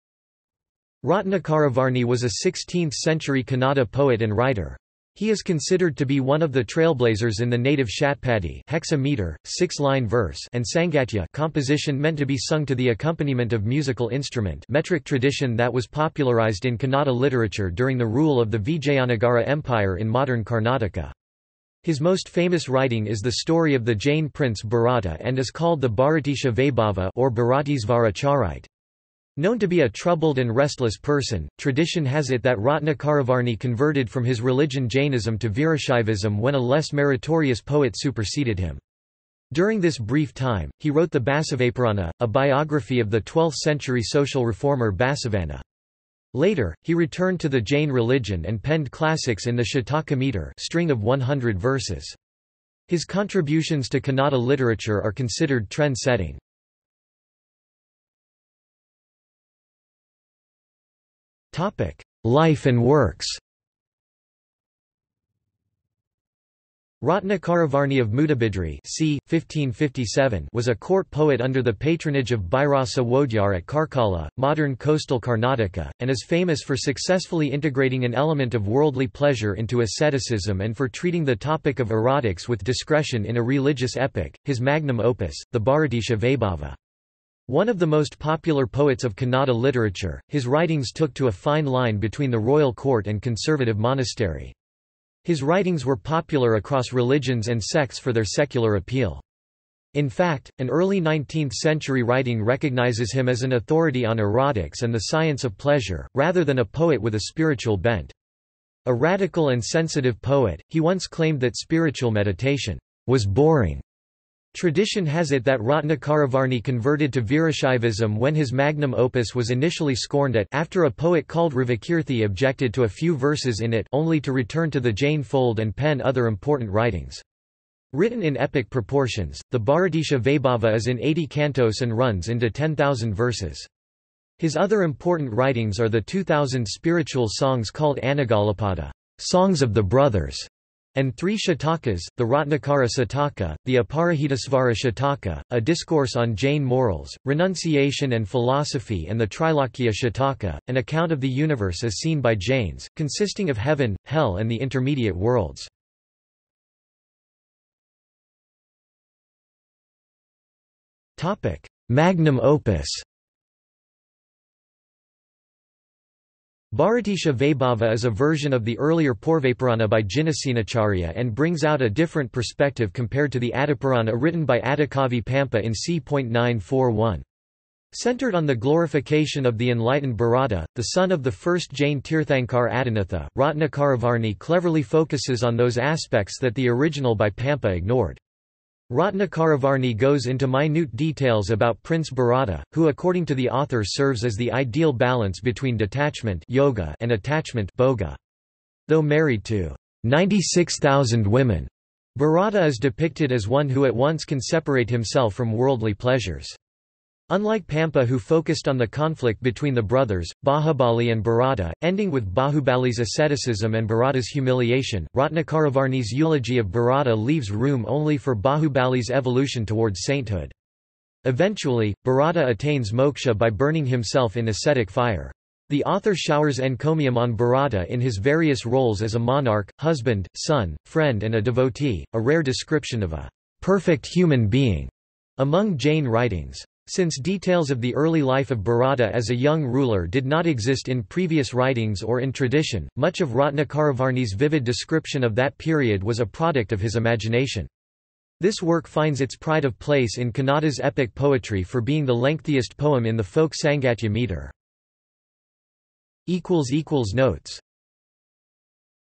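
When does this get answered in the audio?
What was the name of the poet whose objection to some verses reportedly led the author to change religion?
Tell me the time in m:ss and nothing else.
2:01.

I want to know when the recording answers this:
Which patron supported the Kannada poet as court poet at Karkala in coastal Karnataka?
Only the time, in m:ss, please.
1:12.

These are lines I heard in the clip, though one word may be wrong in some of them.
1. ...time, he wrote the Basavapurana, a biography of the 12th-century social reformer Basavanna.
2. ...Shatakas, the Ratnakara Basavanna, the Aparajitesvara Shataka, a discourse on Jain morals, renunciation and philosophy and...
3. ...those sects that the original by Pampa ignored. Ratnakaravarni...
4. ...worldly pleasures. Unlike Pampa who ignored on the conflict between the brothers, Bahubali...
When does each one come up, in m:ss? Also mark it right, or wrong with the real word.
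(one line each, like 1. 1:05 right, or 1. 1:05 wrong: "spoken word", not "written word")
1. 0:40 right
2. 2:21 wrong: "Shataka", not "Basavanna"
3. 3:05 wrong: "aspects", not "sects"
4. 3:25 wrong: "focused", not "ignored".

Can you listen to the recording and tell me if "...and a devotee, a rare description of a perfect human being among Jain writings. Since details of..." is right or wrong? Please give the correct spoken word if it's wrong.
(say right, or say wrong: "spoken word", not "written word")
right.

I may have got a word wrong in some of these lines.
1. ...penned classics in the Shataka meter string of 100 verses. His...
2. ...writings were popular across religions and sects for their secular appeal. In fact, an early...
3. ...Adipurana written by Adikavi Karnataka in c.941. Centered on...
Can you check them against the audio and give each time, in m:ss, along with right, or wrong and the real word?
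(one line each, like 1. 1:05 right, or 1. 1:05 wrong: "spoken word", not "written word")
1. 0:48 right
2. 1:35 right
3. 2:53 wrong: "Pampa", not "Karnataka".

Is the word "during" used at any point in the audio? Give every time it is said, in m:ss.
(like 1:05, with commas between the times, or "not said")
0:17, 0:39.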